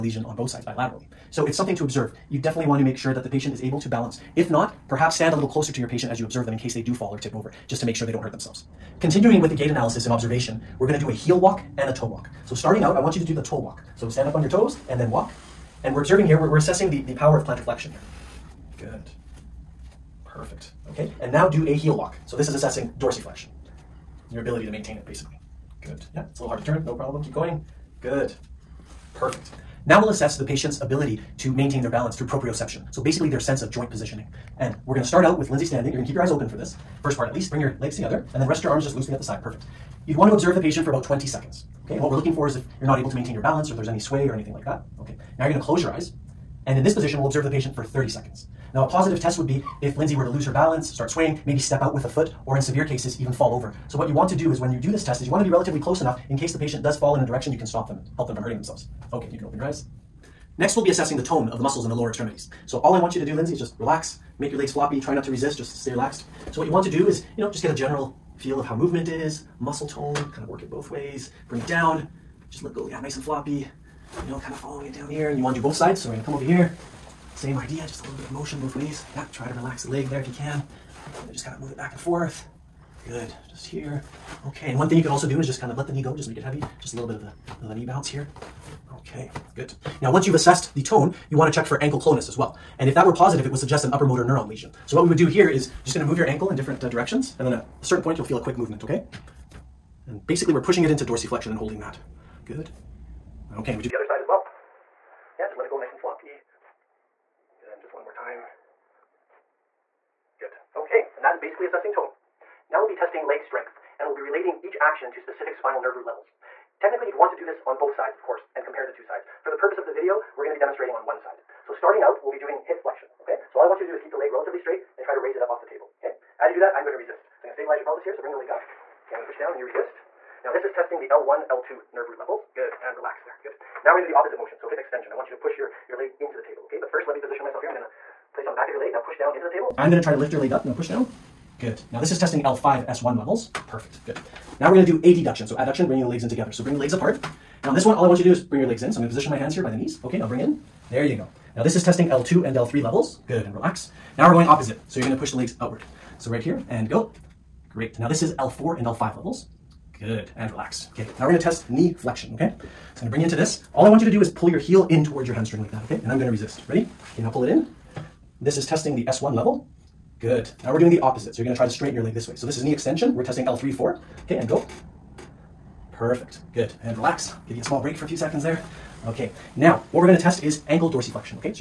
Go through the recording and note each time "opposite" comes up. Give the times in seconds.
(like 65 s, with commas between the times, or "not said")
134 s, 154 s, 171 s.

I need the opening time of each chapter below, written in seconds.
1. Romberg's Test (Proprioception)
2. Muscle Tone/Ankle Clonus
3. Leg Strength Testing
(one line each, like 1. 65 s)
1. 28 s
2. 60 s
3. 112 s.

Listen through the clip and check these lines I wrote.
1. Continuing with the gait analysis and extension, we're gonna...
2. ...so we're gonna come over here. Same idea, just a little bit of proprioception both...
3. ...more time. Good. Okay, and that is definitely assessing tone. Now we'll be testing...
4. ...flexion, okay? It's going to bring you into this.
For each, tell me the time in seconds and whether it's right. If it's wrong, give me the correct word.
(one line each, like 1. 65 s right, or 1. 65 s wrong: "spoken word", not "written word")
1. 9 s wrong: "observation", not "extension"
2. 75 s wrong: "motion", not "proprioception"
3. 108 s wrong: "basically", not "definitely"
4. 161 s right.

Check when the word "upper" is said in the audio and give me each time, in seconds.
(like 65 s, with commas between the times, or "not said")
93 s.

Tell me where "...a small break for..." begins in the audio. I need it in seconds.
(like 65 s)
177 s.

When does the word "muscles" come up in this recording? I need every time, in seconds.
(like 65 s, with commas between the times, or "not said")
61 s, 69 s.